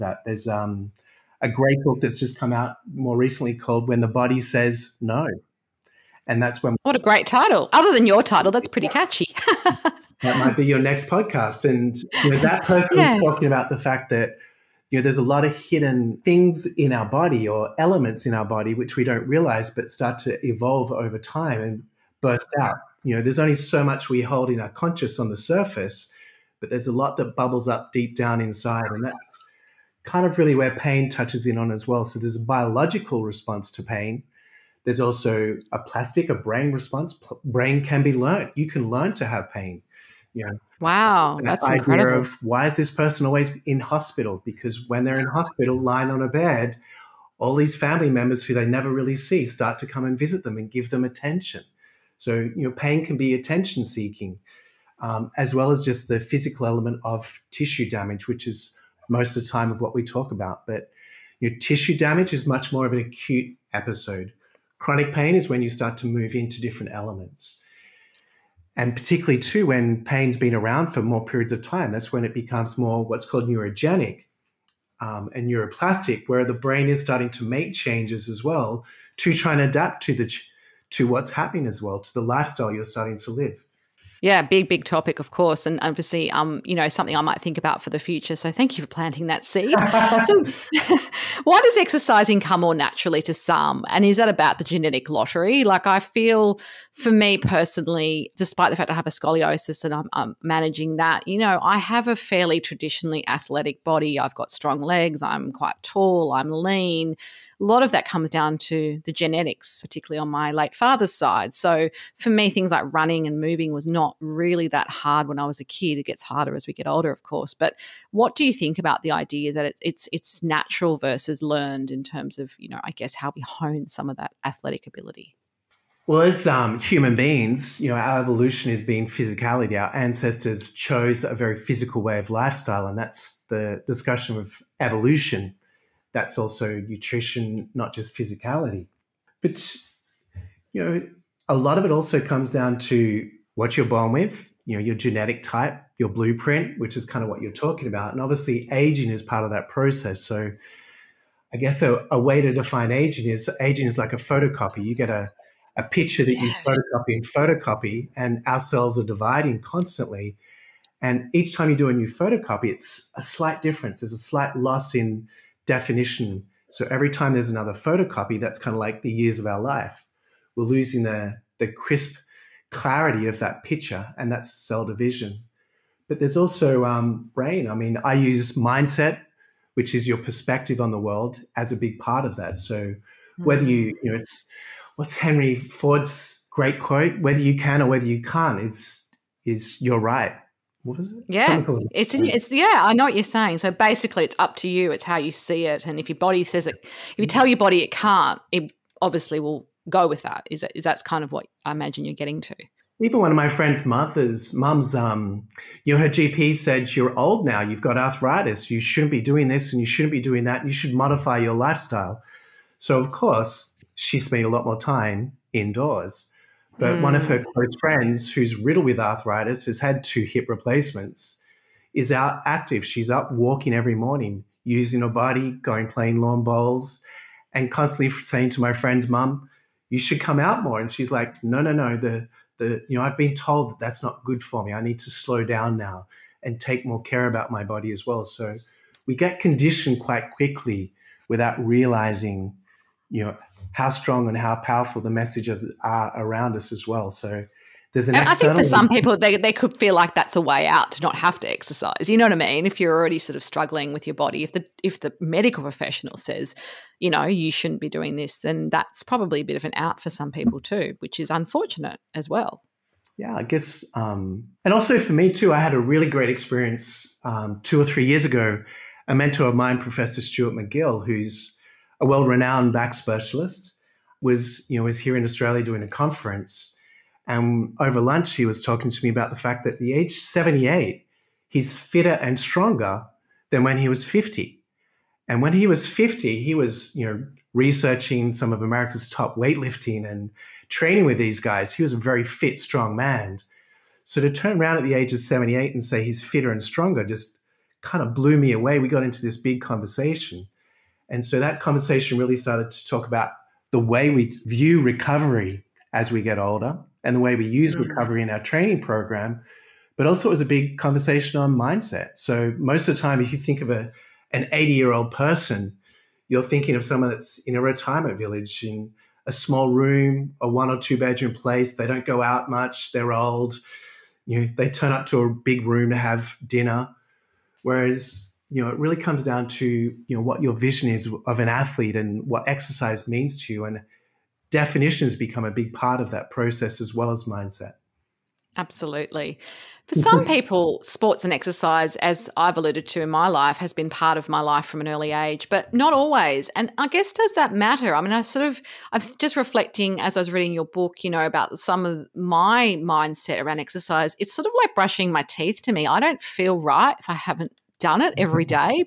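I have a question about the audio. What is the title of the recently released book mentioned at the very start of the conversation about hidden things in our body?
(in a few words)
When the Body Says No.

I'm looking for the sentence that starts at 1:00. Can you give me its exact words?
But your tissue damage is much more of an acute episode.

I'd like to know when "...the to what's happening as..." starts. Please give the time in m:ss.
1:20.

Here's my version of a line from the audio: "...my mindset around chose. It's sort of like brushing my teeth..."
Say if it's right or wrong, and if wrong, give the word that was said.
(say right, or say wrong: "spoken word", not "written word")
wrong: "exercise", not "chose".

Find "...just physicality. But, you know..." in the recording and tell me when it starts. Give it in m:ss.
2:17.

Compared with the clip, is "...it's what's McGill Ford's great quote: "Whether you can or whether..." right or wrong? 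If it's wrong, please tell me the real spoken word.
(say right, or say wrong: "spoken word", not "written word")
wrong: "Henry", not "McGill".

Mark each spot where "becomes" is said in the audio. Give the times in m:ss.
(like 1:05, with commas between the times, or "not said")
1:12, 5:35.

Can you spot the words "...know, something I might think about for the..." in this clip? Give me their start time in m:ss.
1:26.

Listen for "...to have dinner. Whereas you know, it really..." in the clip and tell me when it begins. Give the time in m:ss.
5:25.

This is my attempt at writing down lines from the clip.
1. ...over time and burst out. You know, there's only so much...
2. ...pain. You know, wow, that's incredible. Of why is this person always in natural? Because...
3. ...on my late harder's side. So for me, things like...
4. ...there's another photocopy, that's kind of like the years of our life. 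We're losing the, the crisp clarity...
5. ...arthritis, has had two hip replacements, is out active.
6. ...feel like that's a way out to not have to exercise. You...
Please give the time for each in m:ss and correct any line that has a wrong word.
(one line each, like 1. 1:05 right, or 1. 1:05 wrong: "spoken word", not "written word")
1. 0:20 right
2. 0:39 wrong: "hospital", not "natural"
3. 1:50 wrong: "father", not "harder"
4. 2:47 right
5. 3:38 right
6. 4:09 right.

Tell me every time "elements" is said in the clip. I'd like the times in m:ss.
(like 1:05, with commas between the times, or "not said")
0:17, 0:56, 1:06.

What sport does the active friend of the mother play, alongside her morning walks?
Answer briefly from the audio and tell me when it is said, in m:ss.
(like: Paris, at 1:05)
Lawn bowls, at 3:46.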